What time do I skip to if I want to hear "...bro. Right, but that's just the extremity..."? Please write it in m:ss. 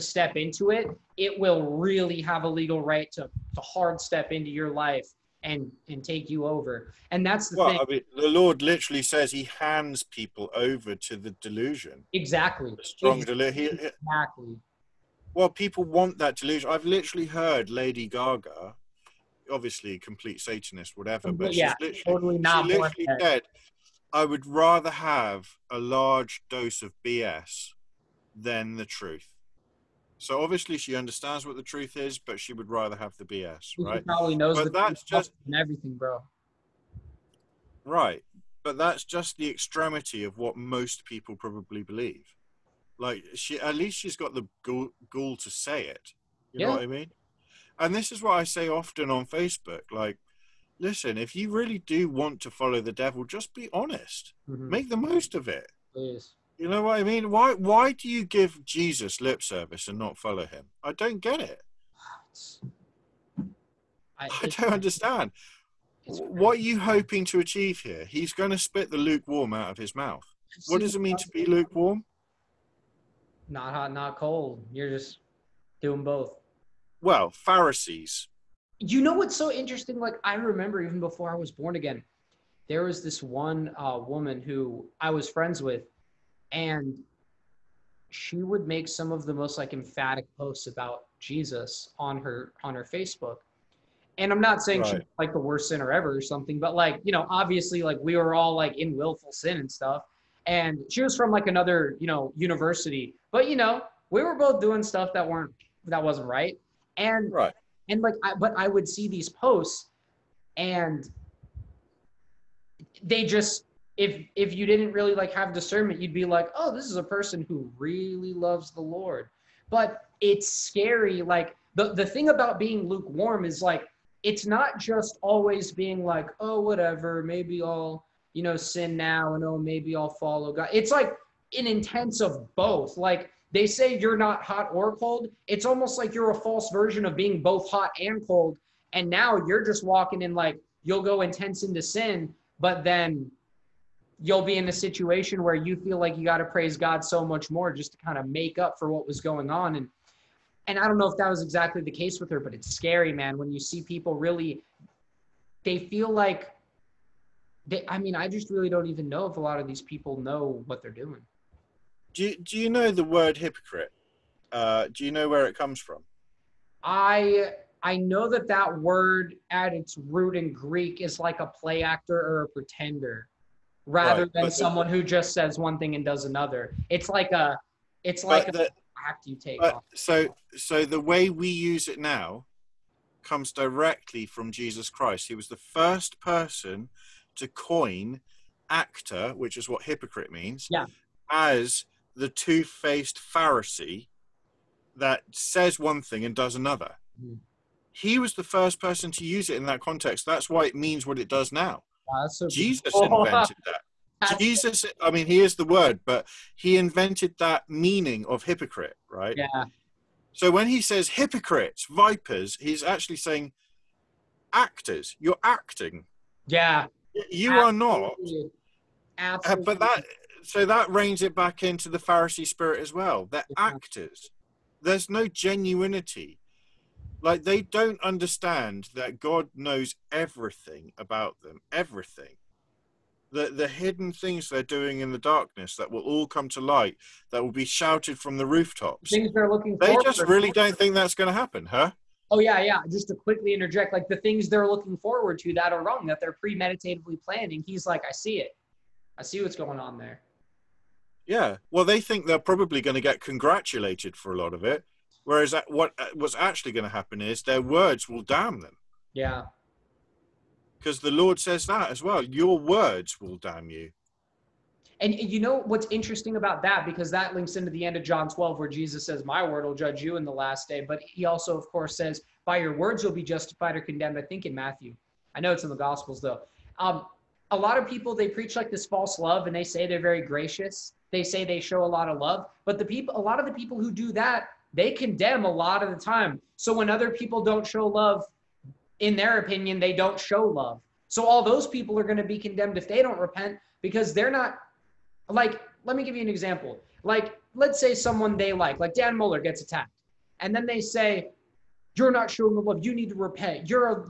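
0:35.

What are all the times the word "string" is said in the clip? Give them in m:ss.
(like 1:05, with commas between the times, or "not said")
not said.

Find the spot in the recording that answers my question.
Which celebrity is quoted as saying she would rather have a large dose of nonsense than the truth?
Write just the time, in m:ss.
0:17.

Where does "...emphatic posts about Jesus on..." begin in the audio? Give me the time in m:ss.
1:29.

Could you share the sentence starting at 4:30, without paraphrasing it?
But he also, of course, says, By your words you'll be justified or condemned, I think in Matthew.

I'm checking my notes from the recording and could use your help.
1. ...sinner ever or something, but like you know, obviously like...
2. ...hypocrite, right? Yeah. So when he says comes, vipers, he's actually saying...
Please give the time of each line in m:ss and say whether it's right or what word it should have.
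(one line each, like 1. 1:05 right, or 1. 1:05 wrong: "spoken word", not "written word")
1. 1:35 right
2. 3:28 wrong: "hypocrites", not "comes".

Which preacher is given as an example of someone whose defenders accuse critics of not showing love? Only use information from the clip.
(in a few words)
Dan Mohler.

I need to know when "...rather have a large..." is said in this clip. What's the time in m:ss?
0:24.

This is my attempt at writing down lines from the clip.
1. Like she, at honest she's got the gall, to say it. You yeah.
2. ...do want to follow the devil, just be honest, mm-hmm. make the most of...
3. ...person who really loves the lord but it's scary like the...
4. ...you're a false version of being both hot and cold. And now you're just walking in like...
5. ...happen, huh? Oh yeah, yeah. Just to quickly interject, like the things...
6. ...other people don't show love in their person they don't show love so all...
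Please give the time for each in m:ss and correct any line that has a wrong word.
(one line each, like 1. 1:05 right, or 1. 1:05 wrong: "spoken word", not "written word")
1. 0:42 wrong: "least", not "honest"
2. 0:51 right
3. 1:57 right
4. 2:16 right
5. 4:01 right
6. 4:46 wrong: "opinion", not "person".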